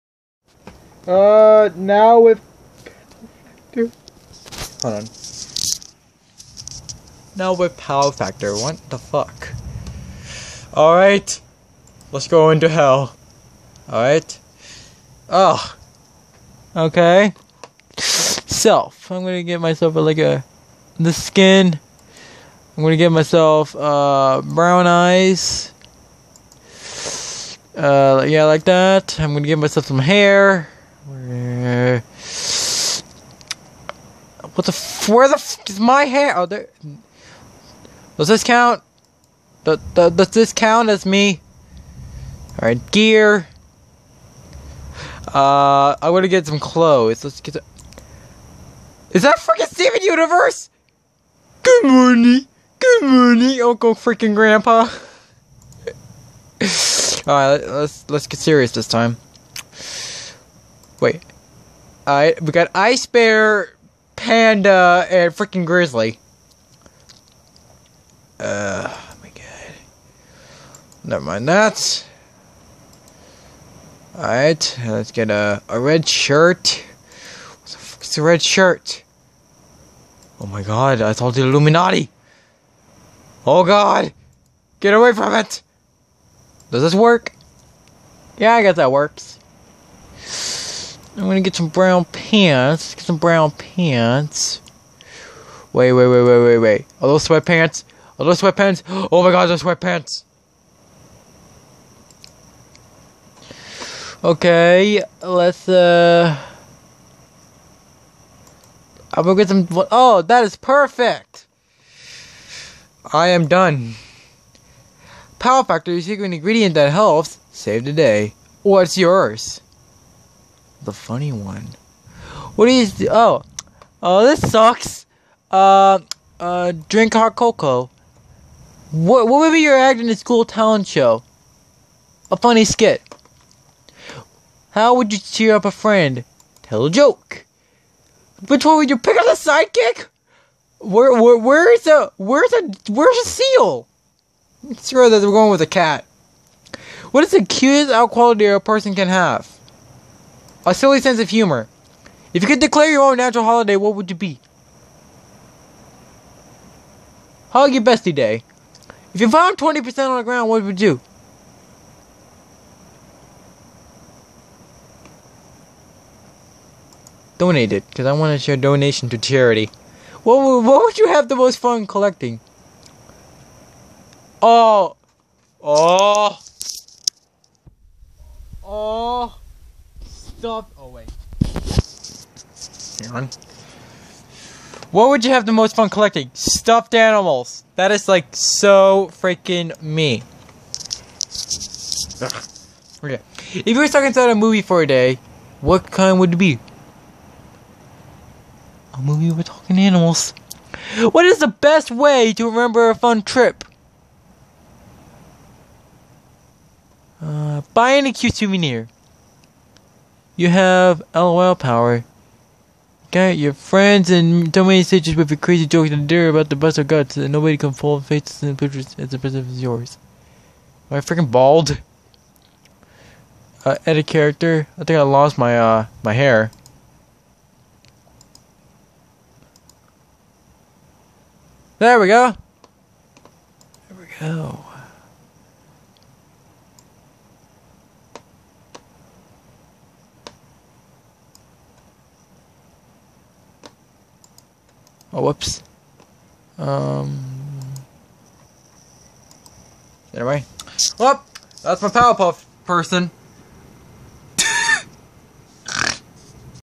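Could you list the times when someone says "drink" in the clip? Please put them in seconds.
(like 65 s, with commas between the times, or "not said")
126 s.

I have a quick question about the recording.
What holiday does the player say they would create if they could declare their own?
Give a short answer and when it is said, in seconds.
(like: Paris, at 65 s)
Hug your bestie day, at 157 s.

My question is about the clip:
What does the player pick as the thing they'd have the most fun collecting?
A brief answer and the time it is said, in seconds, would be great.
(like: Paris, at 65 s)
Stuffed animals, at 186 s.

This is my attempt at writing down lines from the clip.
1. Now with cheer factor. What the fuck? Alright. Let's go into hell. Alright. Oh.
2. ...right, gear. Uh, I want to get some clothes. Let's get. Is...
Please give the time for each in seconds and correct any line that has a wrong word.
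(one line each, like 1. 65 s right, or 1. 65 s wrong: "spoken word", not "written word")
1. 7 s wrong: "power", not "cheer"
2. 42 s right.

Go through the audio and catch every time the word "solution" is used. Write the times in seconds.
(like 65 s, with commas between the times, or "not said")
not said.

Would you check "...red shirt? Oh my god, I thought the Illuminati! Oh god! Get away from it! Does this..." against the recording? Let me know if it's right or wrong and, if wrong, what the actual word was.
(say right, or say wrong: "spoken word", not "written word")
right.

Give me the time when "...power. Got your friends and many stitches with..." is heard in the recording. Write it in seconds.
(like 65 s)
211 s.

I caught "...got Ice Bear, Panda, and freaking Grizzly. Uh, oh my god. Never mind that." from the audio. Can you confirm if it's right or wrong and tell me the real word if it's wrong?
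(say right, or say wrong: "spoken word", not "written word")
right.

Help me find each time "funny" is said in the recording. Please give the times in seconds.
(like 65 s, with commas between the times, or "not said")
120 s, 132 s.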